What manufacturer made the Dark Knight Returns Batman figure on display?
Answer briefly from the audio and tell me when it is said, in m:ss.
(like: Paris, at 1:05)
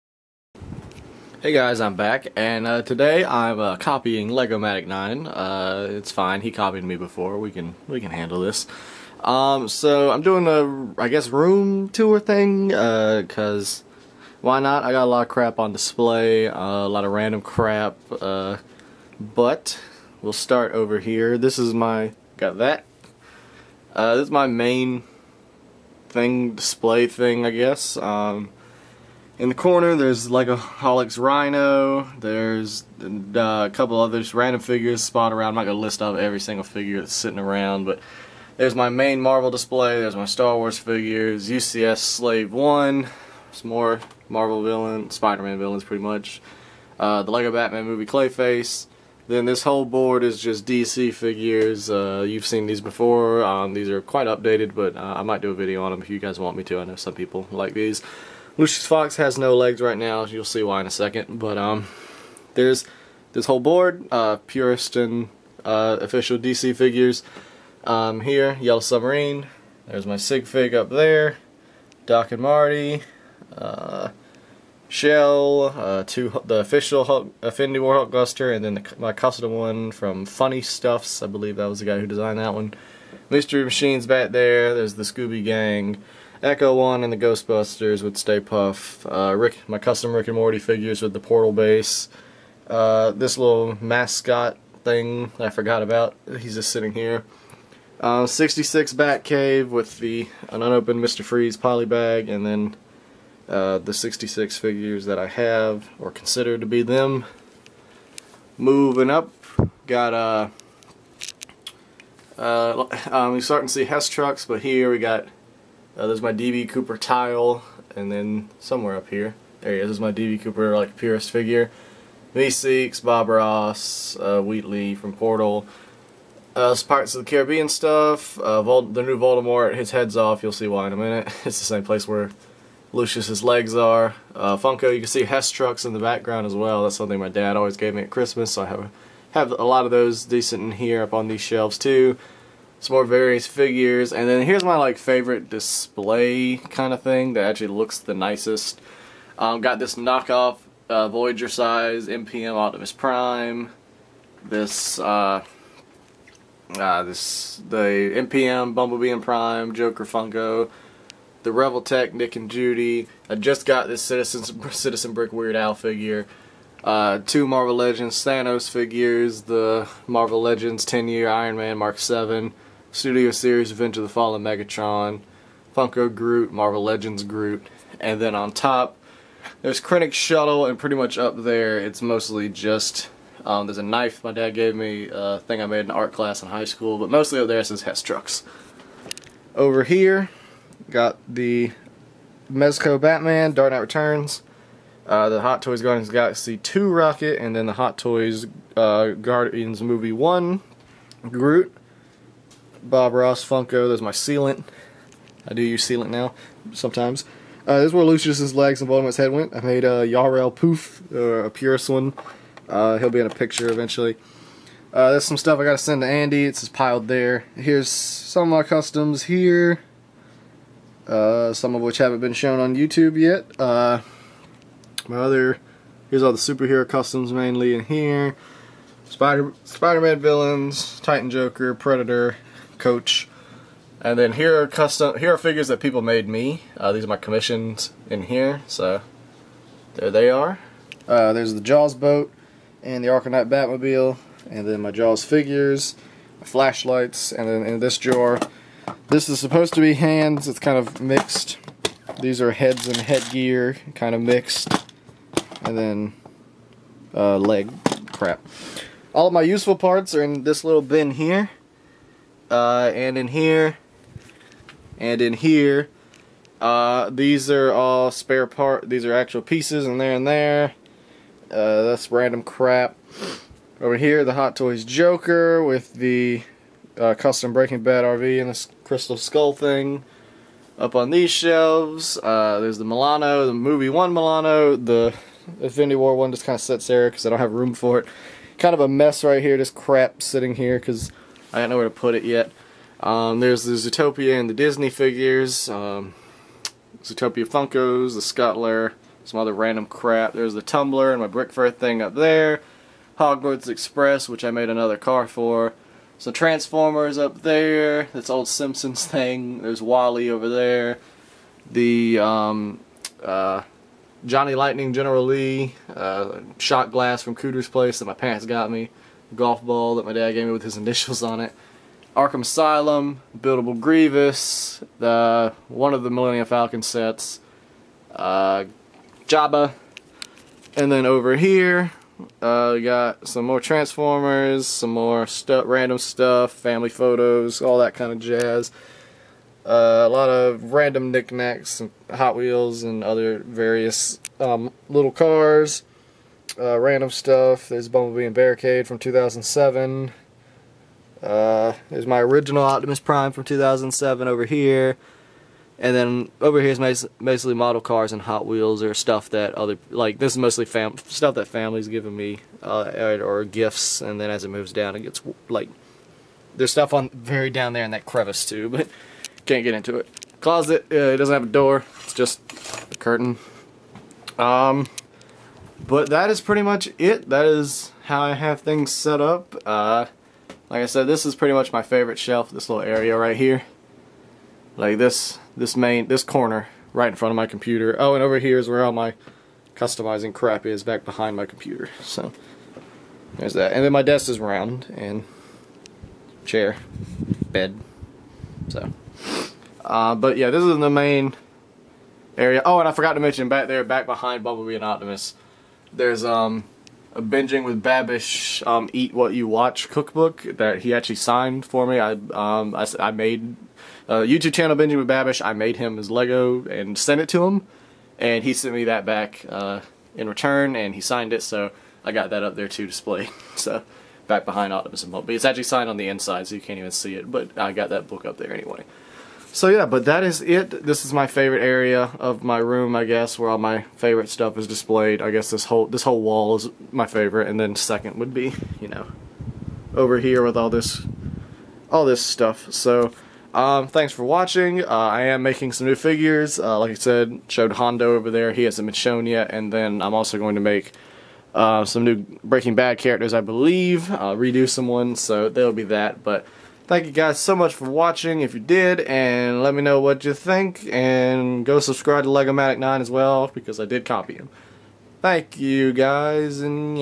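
Mezco, at 3:12.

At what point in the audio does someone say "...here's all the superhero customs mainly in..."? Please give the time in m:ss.
3:46.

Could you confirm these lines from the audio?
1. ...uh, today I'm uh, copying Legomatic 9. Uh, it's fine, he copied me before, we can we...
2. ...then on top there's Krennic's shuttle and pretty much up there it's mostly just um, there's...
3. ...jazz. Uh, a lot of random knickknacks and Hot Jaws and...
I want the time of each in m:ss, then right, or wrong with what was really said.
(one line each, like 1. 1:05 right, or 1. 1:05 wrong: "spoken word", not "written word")
1. 0:02 right
2. 2:58 right
3. 5:38 wrong: "Wheels", not "Jaws".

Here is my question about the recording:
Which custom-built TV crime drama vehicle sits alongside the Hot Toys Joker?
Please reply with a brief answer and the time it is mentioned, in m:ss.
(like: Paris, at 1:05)
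Breaking Bad RV, at 4:37.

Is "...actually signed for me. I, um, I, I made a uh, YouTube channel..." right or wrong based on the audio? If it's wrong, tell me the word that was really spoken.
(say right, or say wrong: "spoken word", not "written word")
right.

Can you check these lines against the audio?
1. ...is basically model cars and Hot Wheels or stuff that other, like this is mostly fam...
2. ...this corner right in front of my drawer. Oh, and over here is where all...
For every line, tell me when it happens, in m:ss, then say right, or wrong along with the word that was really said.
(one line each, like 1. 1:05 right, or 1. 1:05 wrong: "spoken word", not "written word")
1. 5:56 right
2. 6:26 wrong: "computer", not "drawer".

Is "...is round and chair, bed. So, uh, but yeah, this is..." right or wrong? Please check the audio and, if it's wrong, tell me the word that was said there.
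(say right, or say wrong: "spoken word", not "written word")
right.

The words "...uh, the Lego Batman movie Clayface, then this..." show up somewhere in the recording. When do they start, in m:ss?
0:46.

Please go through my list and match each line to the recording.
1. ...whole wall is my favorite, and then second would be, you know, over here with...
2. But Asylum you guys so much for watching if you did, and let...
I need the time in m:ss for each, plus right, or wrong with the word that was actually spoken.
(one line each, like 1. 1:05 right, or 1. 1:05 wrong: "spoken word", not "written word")
1. 7:16 right
2. 7:36 wrong: "Thank", not "Asylum".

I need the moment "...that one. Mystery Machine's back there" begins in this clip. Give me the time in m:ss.
1:22.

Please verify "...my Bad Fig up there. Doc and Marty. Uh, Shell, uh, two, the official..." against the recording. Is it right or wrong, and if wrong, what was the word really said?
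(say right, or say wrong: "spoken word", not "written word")
wrong: "Sig", not "Bad".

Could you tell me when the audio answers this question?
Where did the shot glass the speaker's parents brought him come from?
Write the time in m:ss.
5:17.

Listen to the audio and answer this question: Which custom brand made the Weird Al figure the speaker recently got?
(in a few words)
Citizen Brick.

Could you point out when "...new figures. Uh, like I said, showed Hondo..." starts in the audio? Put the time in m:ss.
7:25.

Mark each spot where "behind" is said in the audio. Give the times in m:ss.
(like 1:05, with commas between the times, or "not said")
6:31, 6:44, 7:04.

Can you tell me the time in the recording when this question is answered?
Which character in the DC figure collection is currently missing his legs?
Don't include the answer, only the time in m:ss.
0:58.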